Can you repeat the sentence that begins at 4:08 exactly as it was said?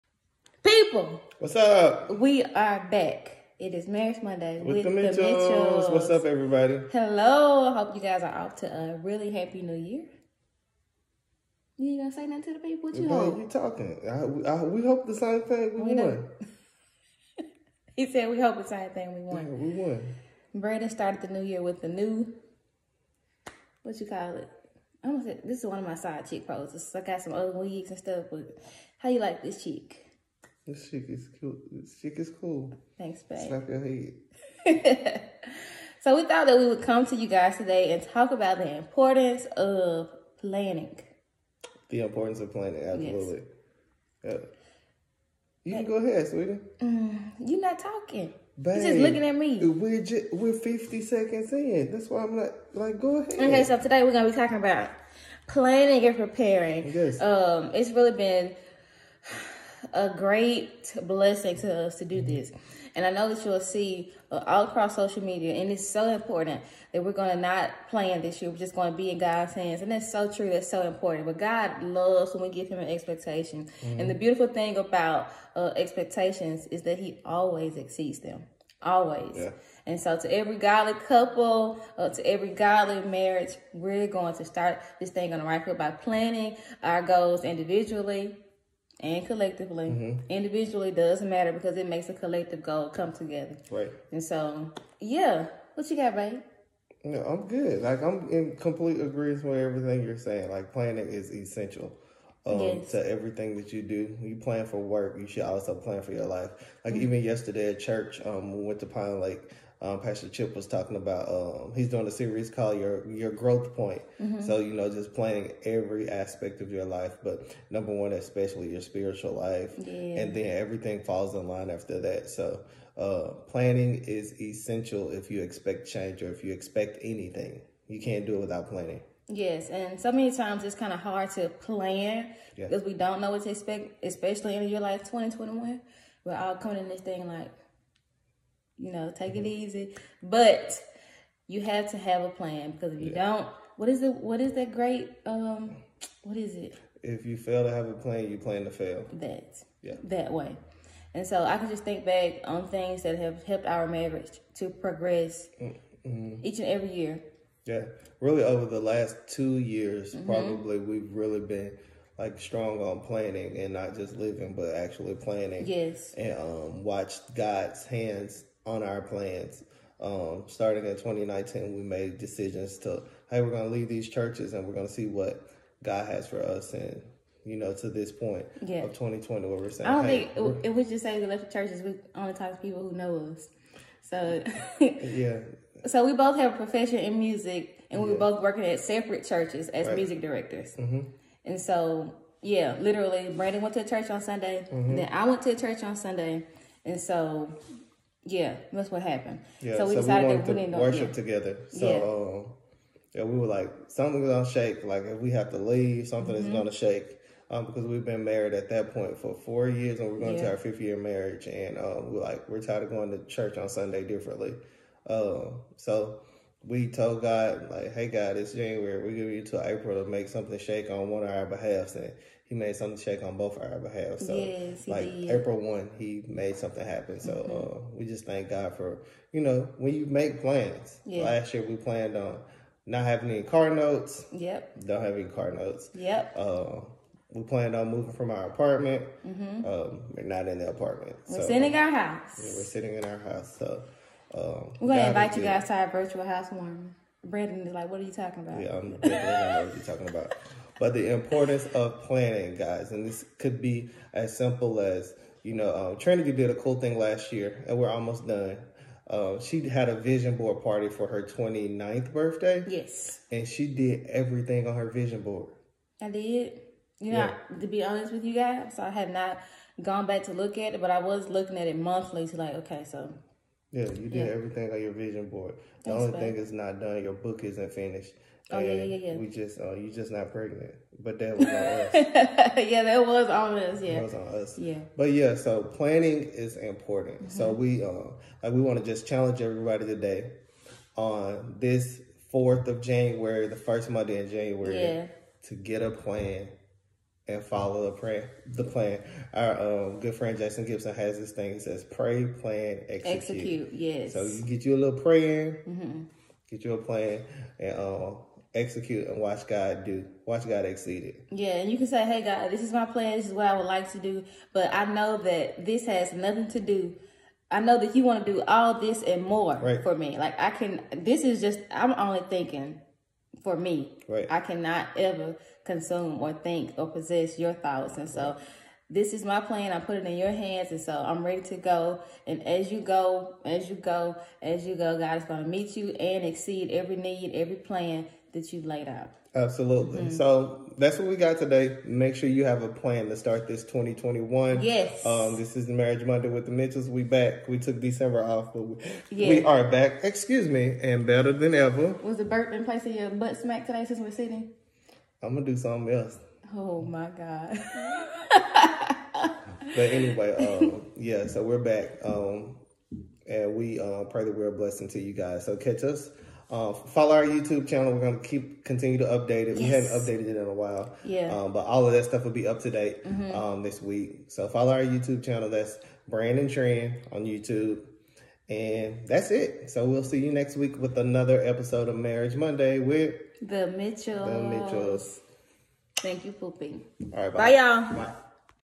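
Yeah, I'm, I know what you're talking about.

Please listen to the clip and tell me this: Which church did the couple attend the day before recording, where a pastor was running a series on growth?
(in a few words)
Pinelake.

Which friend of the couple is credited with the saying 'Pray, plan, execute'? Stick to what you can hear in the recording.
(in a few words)
Jason Gibson.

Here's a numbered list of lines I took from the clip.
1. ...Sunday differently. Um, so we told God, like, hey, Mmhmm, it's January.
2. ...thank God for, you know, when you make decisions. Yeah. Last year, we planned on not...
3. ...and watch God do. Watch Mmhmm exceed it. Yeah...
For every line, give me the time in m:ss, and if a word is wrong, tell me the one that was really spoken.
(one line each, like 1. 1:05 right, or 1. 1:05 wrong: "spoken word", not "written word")
1. 3:33 wrong: "God", not "Mmhmm"
2. 3:48 wrong: "plans", not "decisions"
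3. 5:09 wrong: "God", not "Mmhmm".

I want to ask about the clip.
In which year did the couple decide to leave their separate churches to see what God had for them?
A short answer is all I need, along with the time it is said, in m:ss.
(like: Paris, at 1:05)
2019, at 2:50.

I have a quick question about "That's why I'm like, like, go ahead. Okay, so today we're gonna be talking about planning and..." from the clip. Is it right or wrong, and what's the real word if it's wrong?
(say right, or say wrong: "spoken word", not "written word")
right.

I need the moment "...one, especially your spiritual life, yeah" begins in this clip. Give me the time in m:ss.
1:57.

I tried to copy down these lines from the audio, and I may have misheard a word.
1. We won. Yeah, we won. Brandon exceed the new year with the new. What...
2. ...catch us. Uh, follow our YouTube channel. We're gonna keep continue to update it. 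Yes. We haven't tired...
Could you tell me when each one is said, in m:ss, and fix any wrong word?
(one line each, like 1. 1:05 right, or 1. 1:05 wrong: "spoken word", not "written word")
1. 0:19 wrong: "started", not "exceed"
2. 6:05 wrong: "updated", not "tired".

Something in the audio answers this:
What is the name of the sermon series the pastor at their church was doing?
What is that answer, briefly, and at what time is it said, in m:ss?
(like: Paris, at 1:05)
Your Growth Point, at 1:52.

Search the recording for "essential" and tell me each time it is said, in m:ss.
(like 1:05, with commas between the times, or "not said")
1:41, 2:04.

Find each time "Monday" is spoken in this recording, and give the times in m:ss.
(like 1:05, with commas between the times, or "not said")
0:04, 4:53, 5:46, 6:22.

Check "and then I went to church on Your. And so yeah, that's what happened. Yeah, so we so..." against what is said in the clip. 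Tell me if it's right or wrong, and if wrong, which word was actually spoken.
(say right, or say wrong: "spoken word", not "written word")
wrong: "Sunday", not "Your".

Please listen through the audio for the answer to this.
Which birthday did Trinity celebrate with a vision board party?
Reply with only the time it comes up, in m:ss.
4:21.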